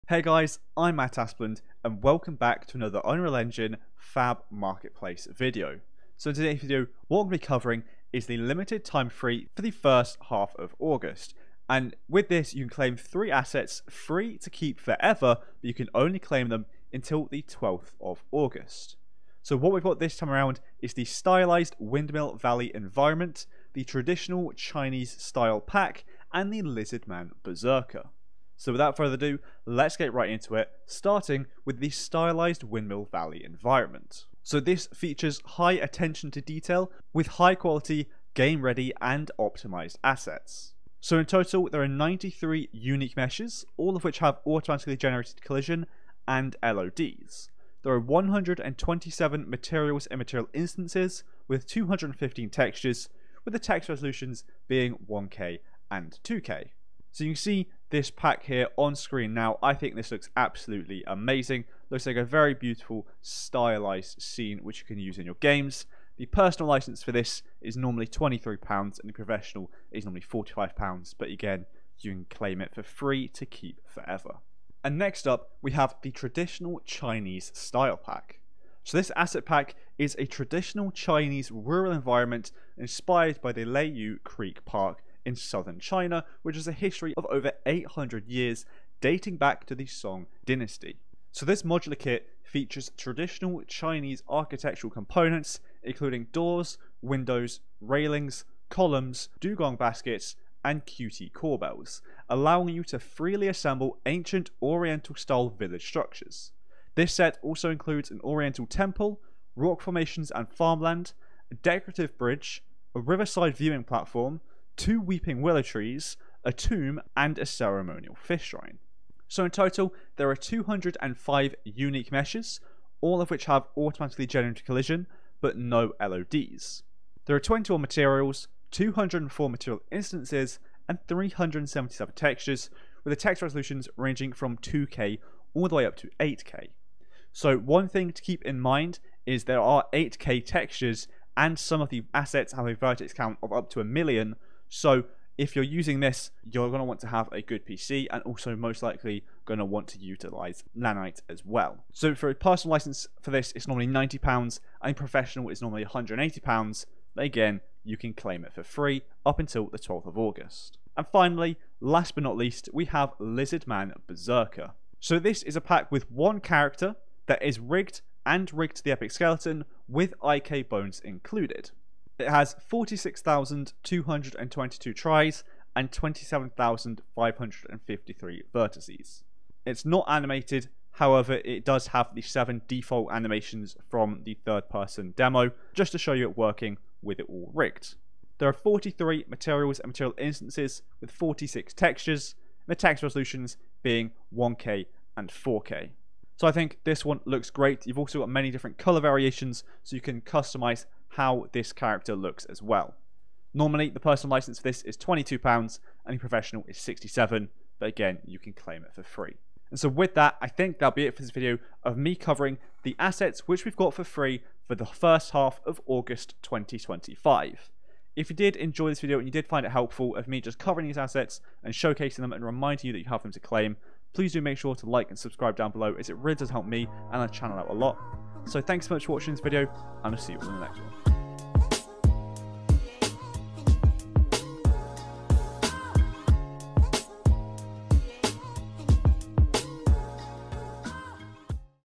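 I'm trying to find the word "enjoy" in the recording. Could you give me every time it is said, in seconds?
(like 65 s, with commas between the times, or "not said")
218 s.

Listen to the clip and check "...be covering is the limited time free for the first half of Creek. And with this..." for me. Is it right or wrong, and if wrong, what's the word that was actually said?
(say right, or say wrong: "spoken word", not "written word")
wrong: "August", not "Creek".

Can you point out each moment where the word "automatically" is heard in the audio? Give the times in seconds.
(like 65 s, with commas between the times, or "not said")
44 s, 123 s.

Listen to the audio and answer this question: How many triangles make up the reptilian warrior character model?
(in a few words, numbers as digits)
46,222.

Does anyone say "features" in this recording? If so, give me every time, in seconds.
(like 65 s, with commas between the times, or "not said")
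34 s, 92 s.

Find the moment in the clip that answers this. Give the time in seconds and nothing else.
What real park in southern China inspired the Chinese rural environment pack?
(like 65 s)
83 s.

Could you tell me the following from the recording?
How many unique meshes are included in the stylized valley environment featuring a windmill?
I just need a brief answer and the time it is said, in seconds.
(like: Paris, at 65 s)
93, at 41 s.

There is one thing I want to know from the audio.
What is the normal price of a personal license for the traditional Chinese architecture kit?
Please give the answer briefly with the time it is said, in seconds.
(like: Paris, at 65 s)
£90, at 153 s.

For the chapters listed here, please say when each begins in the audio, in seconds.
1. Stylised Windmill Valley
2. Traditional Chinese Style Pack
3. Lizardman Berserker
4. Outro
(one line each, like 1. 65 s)
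1. 34 s
2. 74 s
3. 160 s
4. 209 s.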